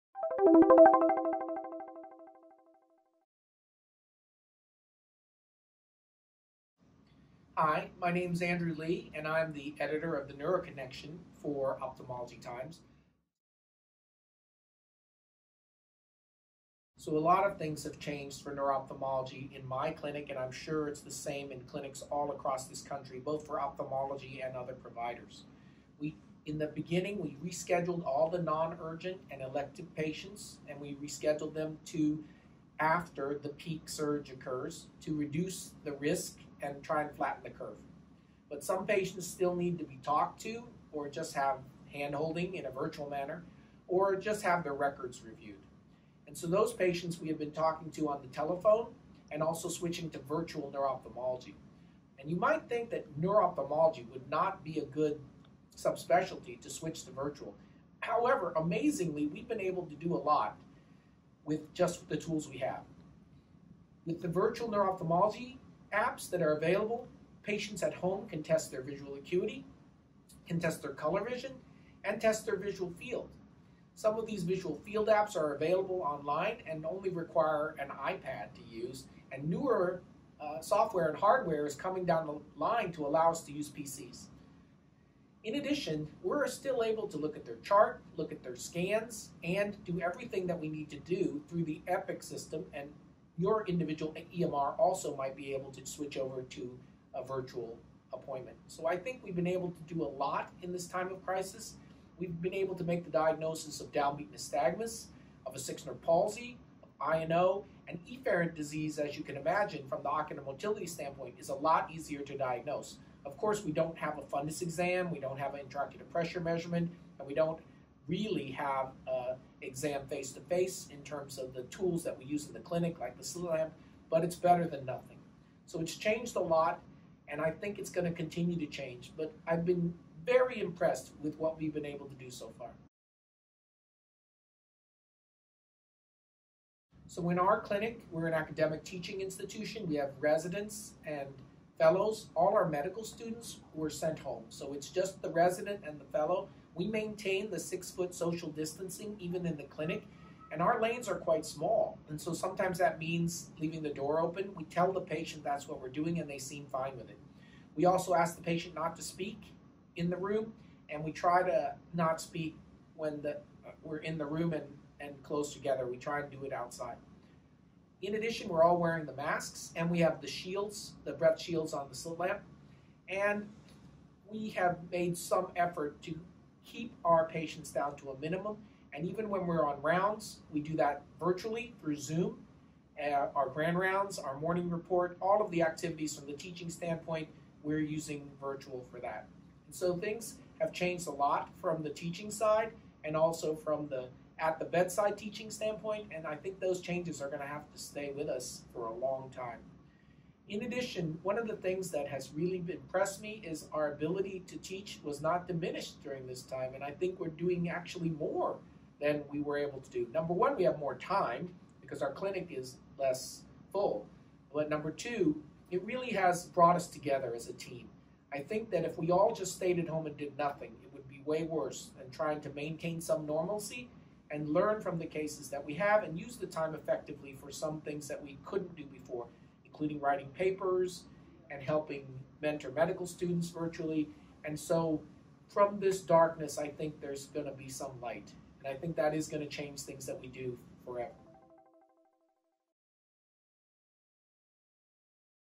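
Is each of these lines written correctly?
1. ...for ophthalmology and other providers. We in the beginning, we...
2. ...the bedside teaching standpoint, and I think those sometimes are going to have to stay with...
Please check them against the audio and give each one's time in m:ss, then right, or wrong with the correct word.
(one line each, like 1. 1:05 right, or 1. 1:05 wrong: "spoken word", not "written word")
1. 0:23 right
2. 3:14 wrong: "changes", not "sometimes".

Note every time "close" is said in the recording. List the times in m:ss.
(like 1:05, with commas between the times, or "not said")
2:45.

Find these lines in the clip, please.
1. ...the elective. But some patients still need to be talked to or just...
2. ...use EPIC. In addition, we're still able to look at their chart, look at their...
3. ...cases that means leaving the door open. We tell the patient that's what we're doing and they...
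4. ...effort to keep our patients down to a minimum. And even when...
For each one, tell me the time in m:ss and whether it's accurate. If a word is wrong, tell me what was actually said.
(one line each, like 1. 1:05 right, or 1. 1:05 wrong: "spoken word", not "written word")
1. 0:37 wrong: "curve", not "elective"
2. 1:23 wrong: "PCs", not "EPIC"
3. 2:32 wrong: "sometimes", not "cases"
4. 2:55 right.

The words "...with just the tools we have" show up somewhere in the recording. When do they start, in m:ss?
1:01.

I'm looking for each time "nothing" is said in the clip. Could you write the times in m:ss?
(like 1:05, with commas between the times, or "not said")
2:04, 3:40.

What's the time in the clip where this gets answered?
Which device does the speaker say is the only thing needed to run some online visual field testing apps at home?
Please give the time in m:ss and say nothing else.
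1:17.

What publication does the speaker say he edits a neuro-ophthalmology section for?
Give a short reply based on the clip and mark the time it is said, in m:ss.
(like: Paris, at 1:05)
Ophthalmology Times, at 0:11.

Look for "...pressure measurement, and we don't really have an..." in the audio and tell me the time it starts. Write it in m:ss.
1:56.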